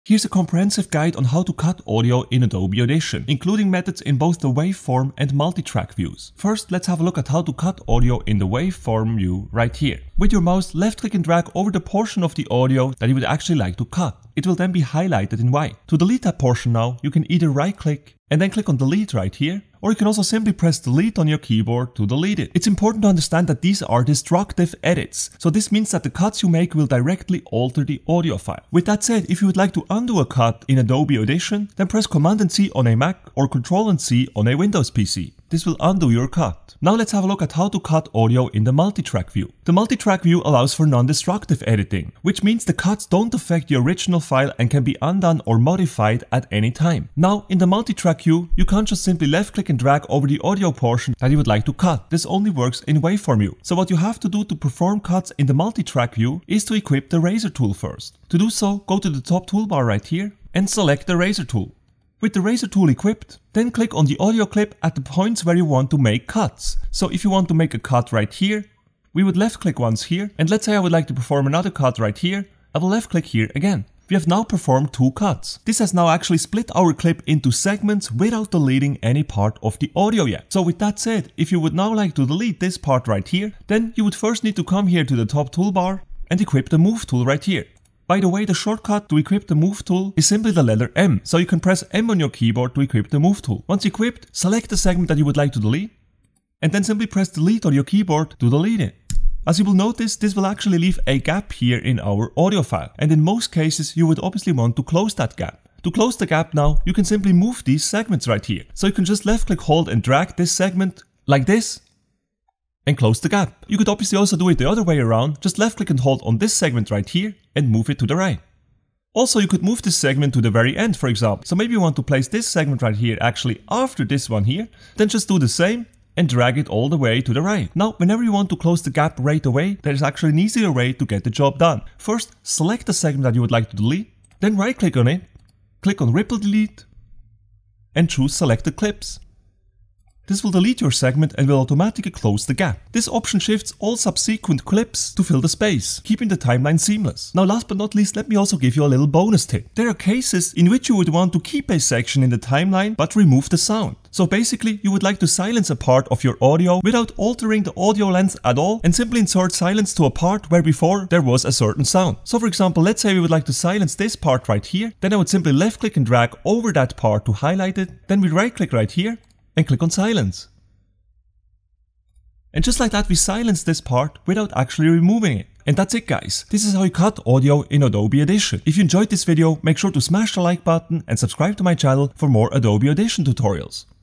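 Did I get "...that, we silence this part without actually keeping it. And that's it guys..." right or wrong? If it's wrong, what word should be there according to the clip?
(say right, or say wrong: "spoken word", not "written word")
wrong: "removing", not "keeping".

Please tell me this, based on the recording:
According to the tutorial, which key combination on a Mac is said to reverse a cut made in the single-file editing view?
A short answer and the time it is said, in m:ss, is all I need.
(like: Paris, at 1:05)
Command and C, at 0:32.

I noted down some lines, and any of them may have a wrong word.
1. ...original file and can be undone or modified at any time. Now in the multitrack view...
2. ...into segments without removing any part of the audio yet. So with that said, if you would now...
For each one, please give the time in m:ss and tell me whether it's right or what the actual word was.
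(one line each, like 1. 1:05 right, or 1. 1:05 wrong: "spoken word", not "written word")
1. 0:43 right
2. 1:17 wrong: "deleting", not "removing".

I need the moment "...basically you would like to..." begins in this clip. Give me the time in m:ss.
2:34.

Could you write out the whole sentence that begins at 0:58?
To do so, go to the top toolbar right here and select the razor tool.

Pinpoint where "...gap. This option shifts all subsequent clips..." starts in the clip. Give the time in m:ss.
2:22.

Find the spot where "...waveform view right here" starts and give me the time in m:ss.
0:08.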